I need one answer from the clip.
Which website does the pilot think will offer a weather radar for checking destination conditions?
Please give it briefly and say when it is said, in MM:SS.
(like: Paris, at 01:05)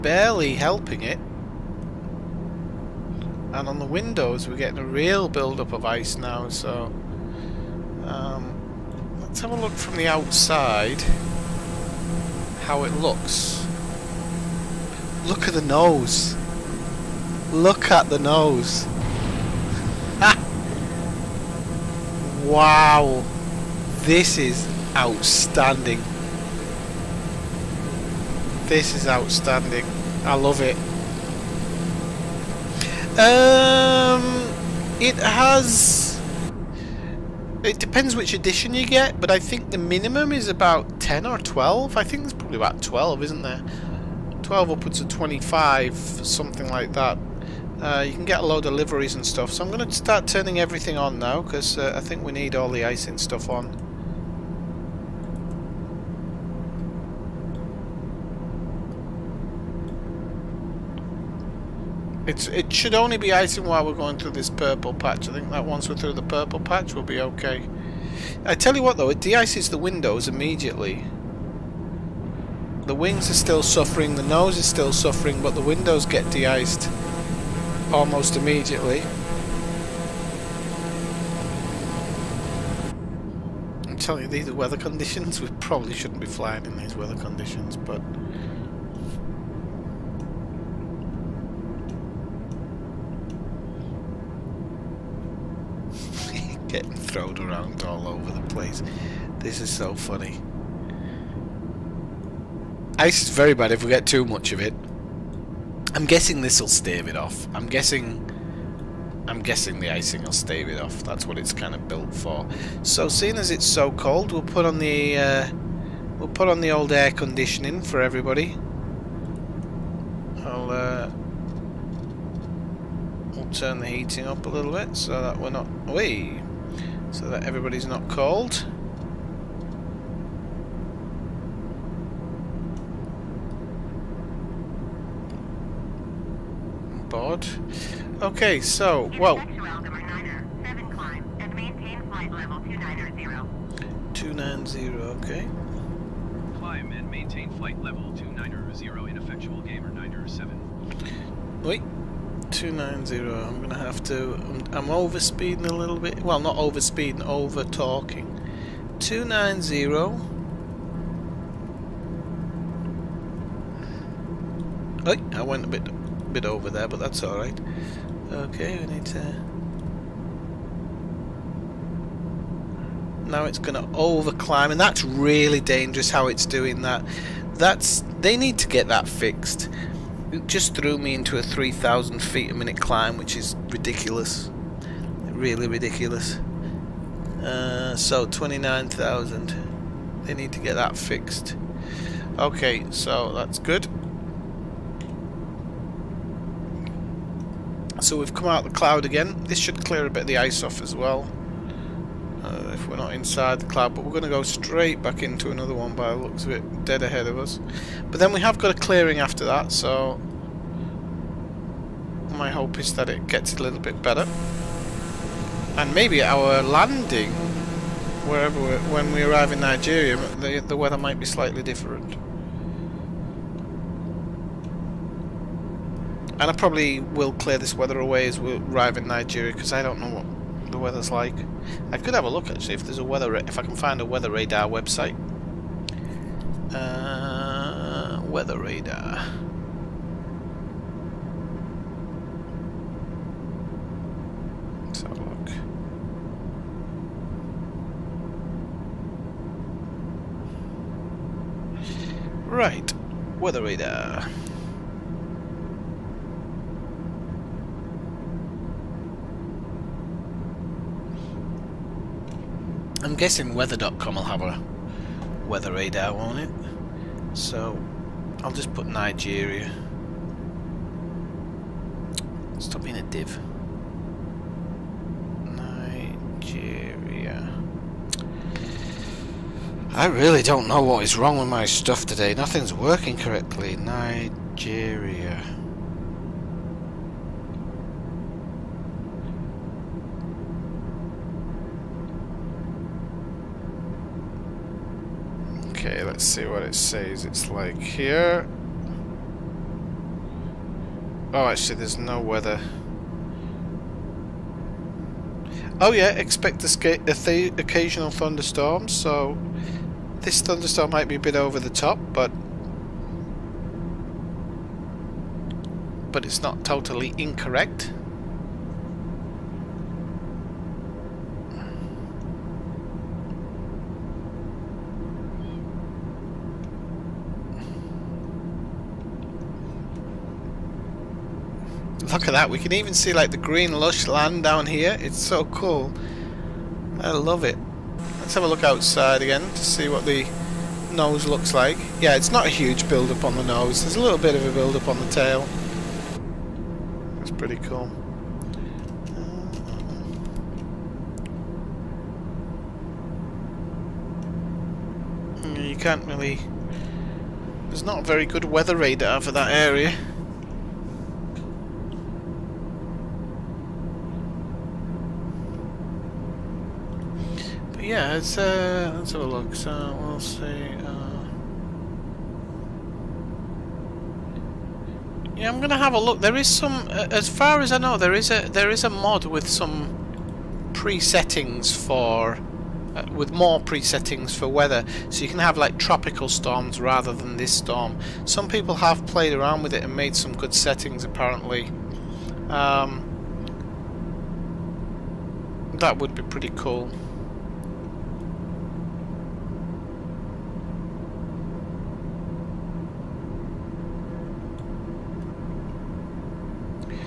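weather.com, at 04:23.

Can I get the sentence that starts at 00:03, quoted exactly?
And on the windows, we're getting a real build-up of ice now, so...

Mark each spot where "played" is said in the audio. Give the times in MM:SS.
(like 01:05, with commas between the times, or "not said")
06:29.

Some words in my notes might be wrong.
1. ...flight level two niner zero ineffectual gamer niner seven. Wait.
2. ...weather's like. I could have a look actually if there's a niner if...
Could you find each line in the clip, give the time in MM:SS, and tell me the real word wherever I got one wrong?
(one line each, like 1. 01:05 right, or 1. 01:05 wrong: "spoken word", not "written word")
1. 02:27 right
2. 03:50 wrong: "weather", not "niner".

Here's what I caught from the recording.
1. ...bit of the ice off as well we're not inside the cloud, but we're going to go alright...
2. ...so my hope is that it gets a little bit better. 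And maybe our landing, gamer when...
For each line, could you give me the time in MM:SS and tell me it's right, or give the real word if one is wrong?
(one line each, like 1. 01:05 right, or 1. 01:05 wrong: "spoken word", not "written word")
1. 03:20 wrong: "straight", not "alright"
2. 03:29 wrong: "wherever", not "gamer".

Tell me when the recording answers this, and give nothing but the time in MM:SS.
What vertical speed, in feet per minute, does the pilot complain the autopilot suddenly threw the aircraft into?
03:01.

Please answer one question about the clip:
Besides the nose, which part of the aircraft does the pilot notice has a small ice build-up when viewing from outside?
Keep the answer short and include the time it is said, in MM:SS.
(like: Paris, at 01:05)
The tail, at 05:44.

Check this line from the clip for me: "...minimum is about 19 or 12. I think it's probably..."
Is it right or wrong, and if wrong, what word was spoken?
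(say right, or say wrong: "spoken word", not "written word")
wrong: "10", not "19".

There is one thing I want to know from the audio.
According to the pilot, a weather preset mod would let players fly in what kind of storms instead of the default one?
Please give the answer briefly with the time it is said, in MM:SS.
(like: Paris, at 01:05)
Tropical storms, at 06:25.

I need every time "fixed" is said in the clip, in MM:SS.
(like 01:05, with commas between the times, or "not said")
02:59, 03:10.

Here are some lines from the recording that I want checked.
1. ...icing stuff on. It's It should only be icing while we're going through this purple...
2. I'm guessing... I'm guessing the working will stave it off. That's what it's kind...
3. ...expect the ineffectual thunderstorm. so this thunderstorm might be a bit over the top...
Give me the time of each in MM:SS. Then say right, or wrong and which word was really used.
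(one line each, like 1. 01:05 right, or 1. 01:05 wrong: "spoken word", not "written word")
1. 00:52 right
2. 01:47 wrong: "icing", not "working"
3. 05:06 wrong: "occasional", not "ineffectual".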